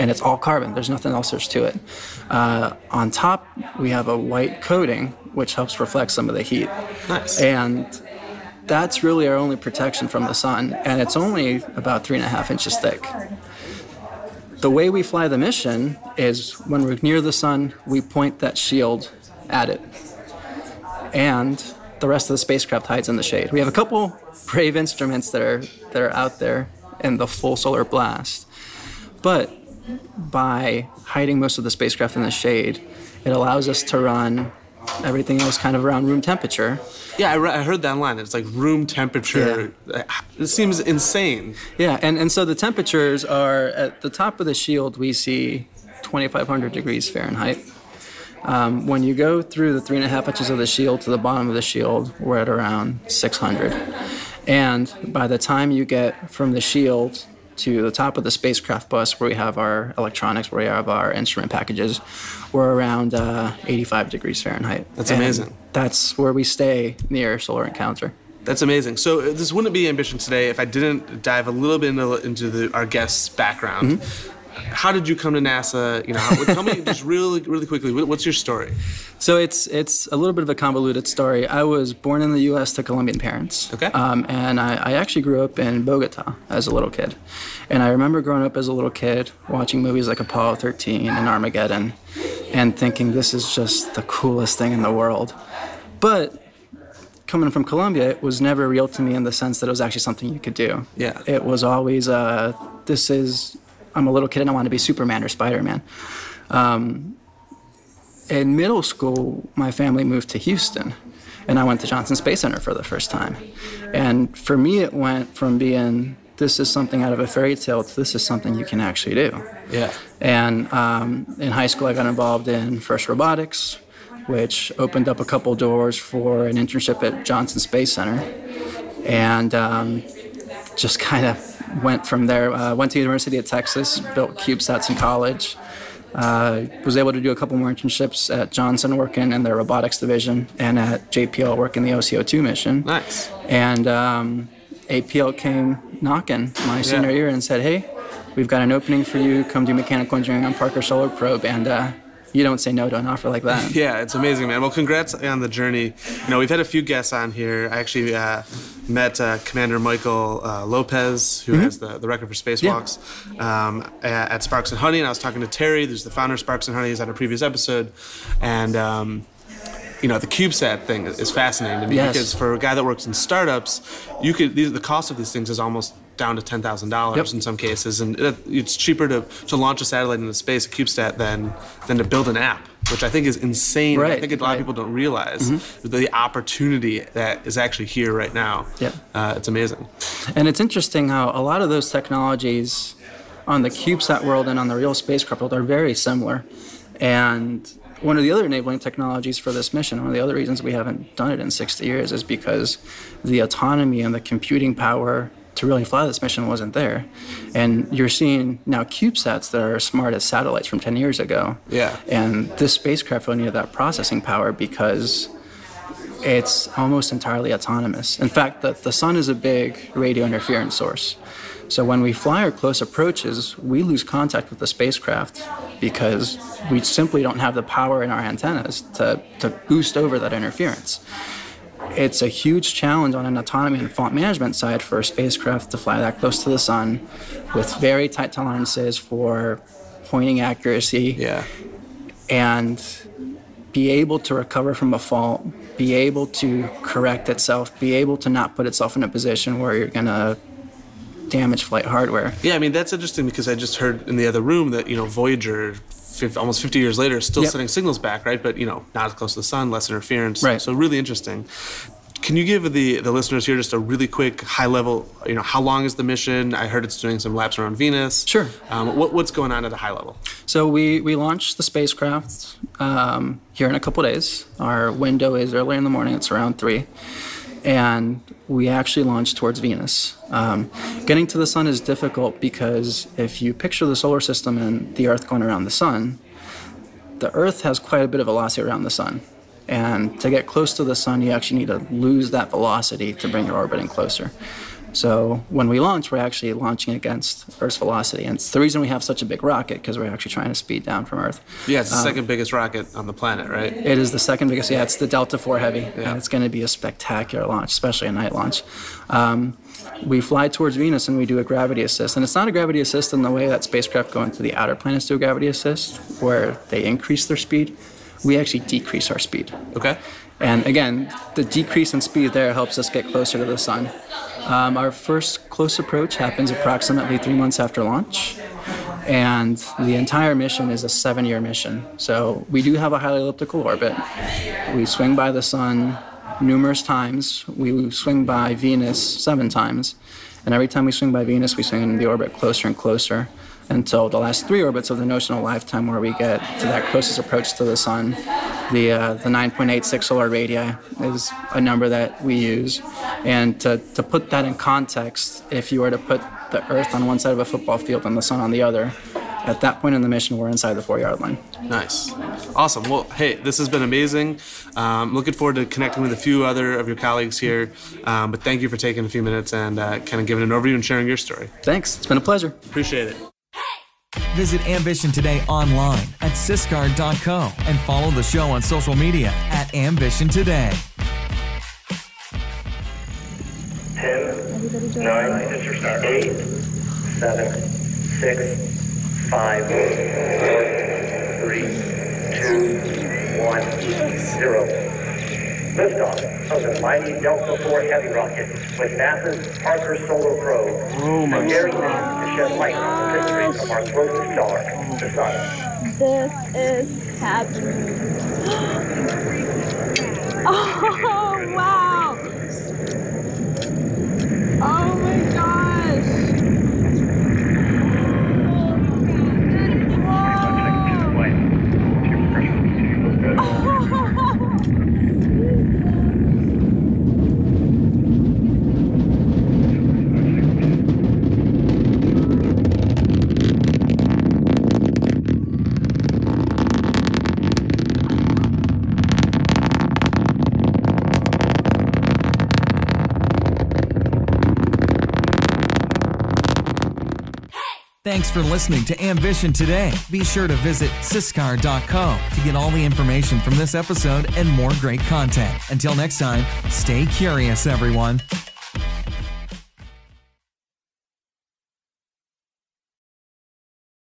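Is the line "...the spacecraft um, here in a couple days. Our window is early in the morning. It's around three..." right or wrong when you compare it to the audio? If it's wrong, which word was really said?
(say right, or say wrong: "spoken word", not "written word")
right.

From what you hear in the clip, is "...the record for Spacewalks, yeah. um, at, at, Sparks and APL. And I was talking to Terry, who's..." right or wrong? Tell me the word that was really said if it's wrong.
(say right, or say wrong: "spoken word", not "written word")
wrong: "Honey", not "APL".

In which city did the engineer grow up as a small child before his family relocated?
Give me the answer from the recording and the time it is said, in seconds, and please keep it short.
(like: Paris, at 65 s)
Bogota, at 85 s.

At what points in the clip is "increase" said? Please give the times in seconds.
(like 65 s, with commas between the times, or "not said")
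316 s.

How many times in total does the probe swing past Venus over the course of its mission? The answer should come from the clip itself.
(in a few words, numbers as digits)
7.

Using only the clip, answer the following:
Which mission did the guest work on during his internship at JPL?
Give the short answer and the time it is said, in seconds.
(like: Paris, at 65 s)
OCO2, at 141 s.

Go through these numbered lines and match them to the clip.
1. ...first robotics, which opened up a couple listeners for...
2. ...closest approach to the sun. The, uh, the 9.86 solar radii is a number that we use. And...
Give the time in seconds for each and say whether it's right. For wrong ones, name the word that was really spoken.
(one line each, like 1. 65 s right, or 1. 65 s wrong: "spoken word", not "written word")
1. 122 s wrong: "doors", not "listeners"
2. 346 s right.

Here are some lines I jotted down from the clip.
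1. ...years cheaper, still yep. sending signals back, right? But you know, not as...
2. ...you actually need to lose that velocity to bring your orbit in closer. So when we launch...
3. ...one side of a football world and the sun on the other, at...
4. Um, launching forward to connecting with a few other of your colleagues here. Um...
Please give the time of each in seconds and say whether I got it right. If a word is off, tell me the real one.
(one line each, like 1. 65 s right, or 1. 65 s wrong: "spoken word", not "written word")
1. 256 s wrong: "later", not "cheaper"
2. 291 s right
3. 357 s wrong: "field", not "world"
4. 364 s wrong: "looking", not "launching".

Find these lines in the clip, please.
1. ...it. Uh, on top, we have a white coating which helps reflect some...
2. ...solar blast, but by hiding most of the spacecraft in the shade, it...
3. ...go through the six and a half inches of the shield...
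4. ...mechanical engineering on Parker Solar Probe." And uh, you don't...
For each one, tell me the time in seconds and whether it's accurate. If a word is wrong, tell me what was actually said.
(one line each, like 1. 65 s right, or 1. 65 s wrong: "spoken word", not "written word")
1. 1 s right
2. 27 s right
3. 49 s wrong: "three", not "six"
4. 149 s right.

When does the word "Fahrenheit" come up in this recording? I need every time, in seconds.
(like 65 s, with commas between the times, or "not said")
47 s, 64 s.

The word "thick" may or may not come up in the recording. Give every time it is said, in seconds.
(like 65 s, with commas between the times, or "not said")
12 s.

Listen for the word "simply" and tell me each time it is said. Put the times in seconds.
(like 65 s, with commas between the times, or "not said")
226 s.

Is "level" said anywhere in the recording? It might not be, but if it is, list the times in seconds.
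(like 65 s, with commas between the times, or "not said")
264 s, 269 s.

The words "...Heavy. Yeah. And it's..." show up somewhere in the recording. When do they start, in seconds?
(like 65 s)
305 s.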